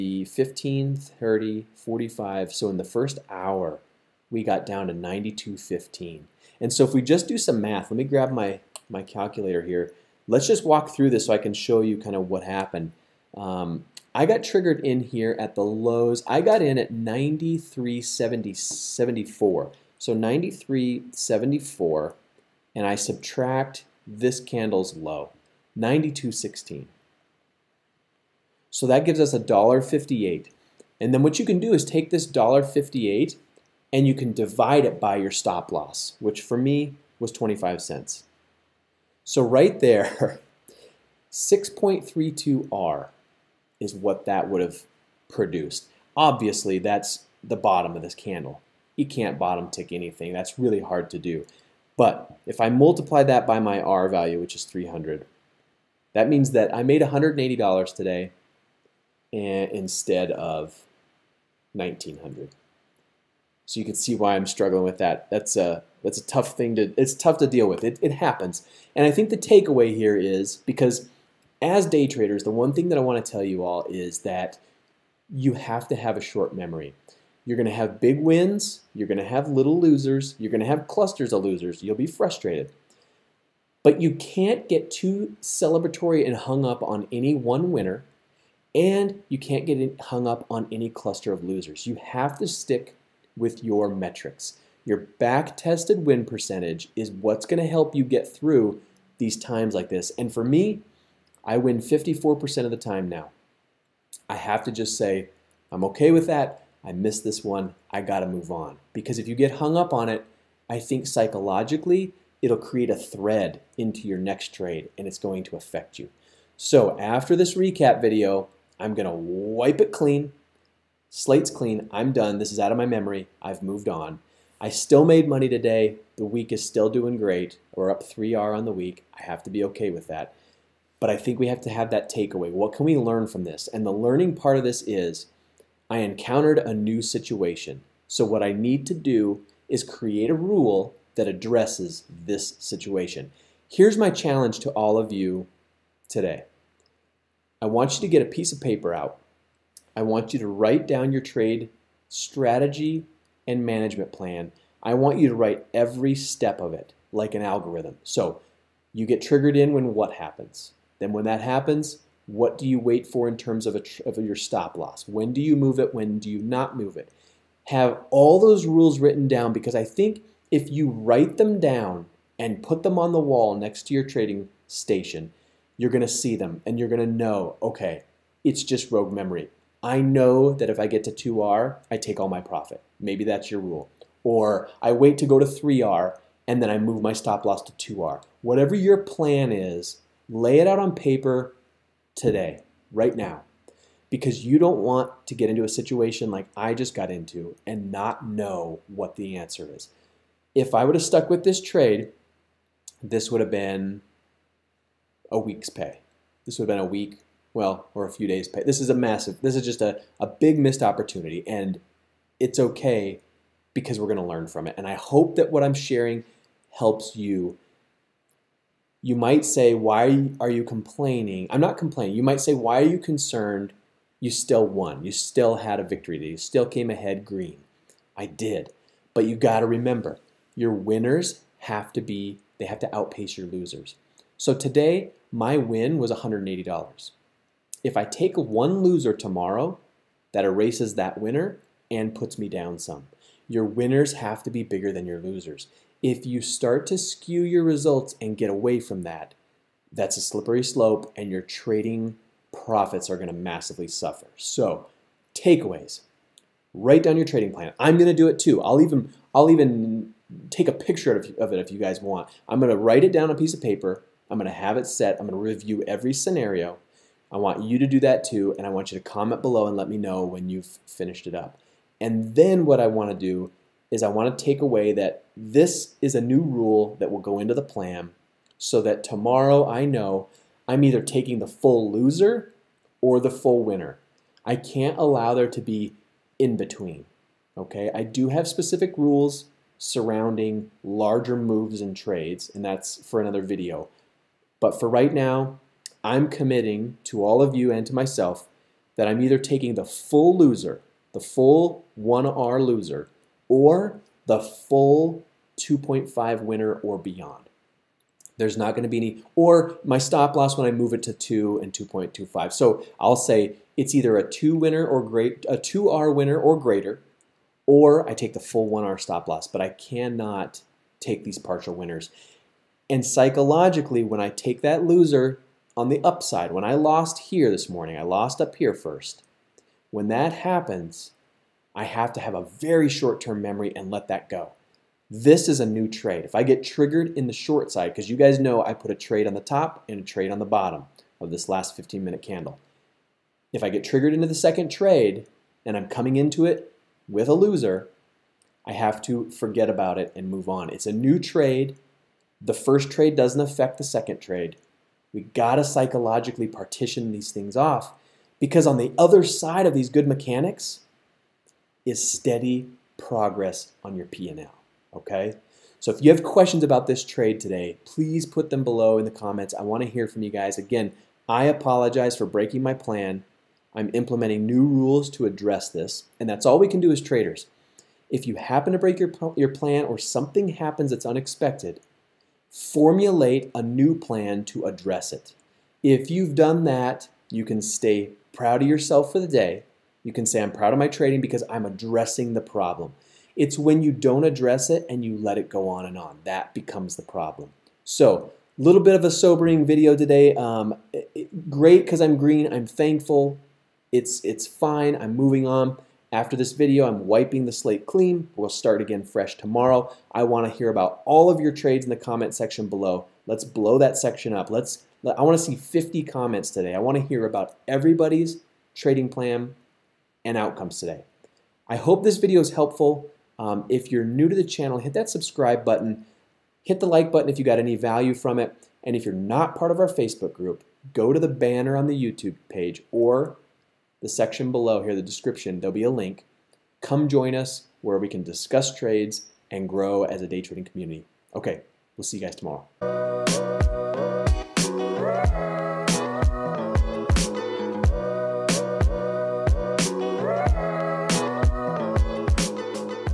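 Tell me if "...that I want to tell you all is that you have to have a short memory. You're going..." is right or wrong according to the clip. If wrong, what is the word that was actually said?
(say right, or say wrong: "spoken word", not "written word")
right.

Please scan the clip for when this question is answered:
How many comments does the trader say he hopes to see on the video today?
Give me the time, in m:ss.
6:55.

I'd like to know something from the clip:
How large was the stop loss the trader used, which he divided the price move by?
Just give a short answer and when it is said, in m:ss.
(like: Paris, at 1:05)
25 cents, at 0:37.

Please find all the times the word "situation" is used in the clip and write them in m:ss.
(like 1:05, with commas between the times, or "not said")
2:17, 2:22, 3:15.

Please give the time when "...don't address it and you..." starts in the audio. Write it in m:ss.
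6:33.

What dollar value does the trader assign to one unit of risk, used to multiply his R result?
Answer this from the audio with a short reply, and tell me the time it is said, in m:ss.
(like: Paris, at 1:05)
300, at 0:54.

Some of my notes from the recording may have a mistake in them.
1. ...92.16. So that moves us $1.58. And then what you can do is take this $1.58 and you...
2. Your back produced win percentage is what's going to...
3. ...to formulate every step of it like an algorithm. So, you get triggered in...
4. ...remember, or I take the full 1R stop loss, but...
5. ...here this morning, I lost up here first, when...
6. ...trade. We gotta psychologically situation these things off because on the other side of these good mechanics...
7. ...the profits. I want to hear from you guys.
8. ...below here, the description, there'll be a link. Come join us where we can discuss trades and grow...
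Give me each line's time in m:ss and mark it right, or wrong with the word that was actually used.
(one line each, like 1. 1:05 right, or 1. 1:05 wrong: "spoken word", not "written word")
1. 0:25 wrong: "gives", not "moves"
2. 1:34 wrong: "tested", not "produced"
3. 2:35 wrong: "write", not "formulate"
4. 5:16 wrong: "greater", not "remember"
5. 5:27 right
6. 5:54 wrong: "partition", not "situation"
7. 6:09 wrong: "comments", not "profits"
8. 7:14 right.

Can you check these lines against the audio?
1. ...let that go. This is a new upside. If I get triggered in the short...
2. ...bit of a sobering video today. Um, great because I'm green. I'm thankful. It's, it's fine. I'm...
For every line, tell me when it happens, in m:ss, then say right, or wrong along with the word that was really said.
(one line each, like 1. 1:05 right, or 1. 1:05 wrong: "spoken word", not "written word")
1. 5:33 wrong: "trade", not "upside"
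2. 6:38 right.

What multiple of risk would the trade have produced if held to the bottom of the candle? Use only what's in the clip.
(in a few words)
6.32R.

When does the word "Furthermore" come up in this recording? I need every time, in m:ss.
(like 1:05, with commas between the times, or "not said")
not said.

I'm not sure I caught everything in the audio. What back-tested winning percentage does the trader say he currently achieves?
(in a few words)
54%.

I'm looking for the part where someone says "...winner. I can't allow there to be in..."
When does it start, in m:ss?
4:43.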